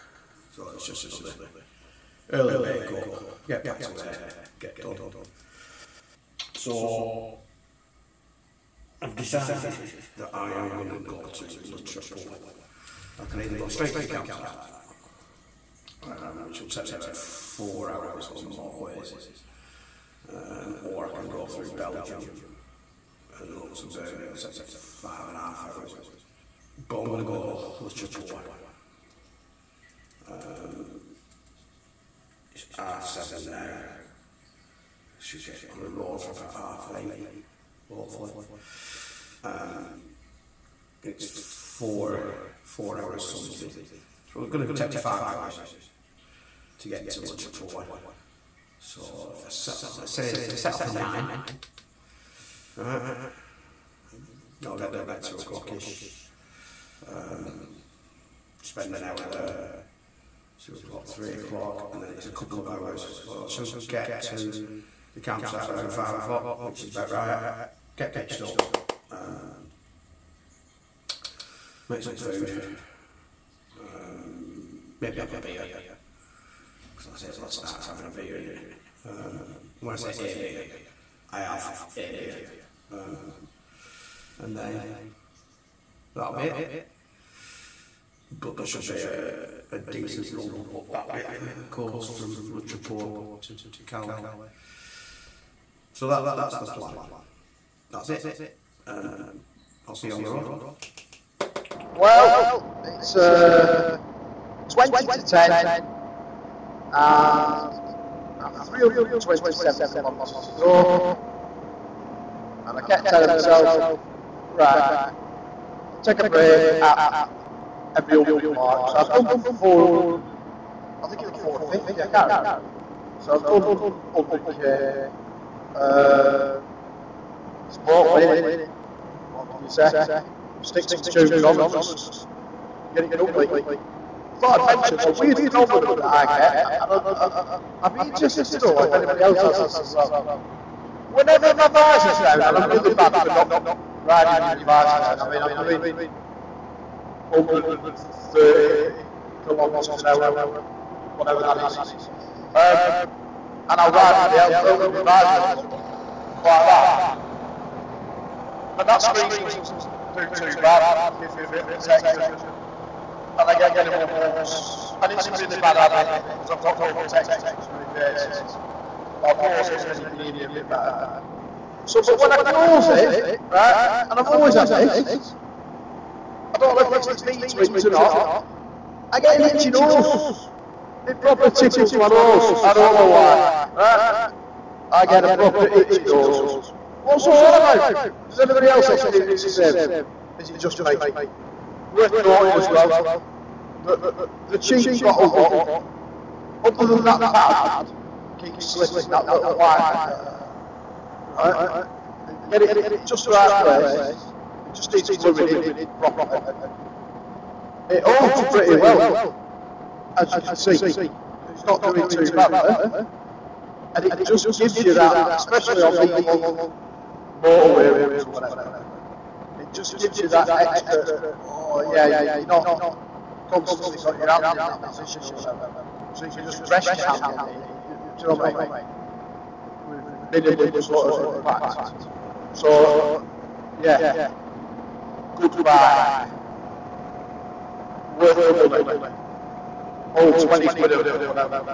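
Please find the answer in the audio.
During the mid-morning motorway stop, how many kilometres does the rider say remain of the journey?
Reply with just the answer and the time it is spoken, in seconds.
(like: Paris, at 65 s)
327, at 108 s.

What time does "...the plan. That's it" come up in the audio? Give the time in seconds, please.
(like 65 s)
96 s.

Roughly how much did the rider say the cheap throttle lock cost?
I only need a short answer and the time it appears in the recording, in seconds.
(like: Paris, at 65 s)
20 quid, at 240 s.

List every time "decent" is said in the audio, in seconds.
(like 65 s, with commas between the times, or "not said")
89 s.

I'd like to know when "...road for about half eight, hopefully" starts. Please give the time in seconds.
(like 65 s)
35 s.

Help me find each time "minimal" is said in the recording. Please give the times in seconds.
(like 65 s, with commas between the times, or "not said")
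163 s, 230 s.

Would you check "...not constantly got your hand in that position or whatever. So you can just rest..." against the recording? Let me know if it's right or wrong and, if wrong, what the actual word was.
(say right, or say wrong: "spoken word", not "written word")
right.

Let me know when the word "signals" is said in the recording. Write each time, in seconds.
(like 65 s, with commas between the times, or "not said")
not said.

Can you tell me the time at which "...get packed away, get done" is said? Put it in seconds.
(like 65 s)
3 s.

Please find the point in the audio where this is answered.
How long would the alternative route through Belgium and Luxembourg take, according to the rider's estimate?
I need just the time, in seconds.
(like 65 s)
24 s.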